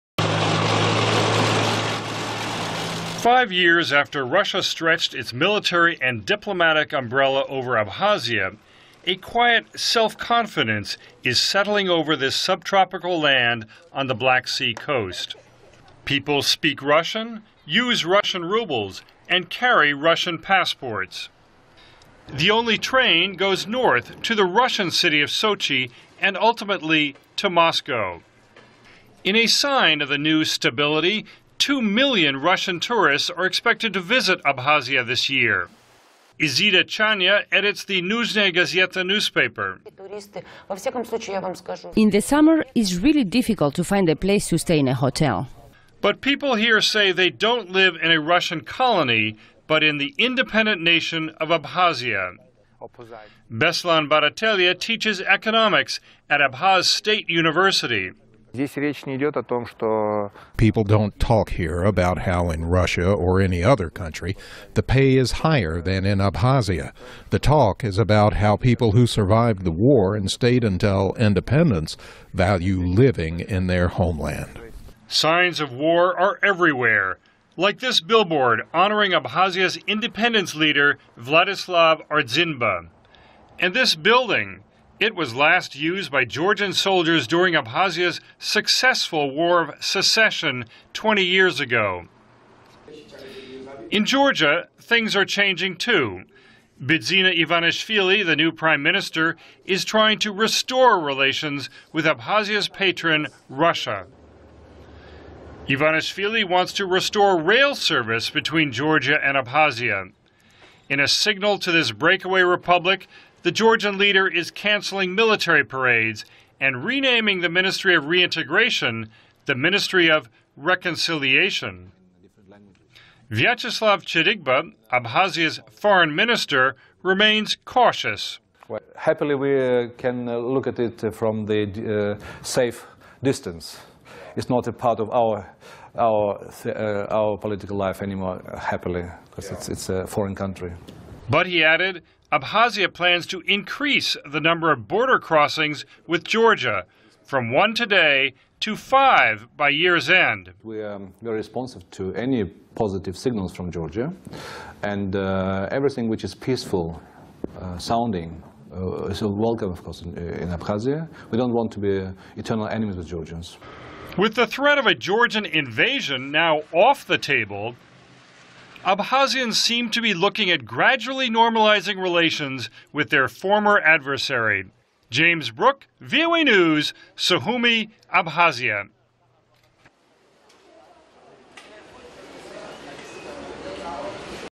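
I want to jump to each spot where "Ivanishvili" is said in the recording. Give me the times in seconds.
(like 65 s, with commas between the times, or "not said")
97 s, 105 s.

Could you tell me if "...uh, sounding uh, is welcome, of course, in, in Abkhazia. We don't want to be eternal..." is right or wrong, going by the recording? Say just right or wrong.
right.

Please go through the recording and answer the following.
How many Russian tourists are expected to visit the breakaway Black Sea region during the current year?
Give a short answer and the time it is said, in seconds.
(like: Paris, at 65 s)
2 million, at 31 s.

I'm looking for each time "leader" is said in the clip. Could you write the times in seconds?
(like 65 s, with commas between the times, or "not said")
80 s, 113 s.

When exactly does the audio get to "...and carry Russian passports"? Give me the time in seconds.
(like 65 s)
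19 s.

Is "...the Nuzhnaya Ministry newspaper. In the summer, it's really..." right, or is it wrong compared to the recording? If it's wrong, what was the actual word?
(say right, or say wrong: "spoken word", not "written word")
wrong: "Gazeta", not "Ministry".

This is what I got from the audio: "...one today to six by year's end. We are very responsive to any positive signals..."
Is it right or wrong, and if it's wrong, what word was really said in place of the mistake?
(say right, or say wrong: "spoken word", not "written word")
wrong: "five", not "six".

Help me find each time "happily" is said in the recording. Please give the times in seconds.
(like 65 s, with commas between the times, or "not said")
128 s, 138 s.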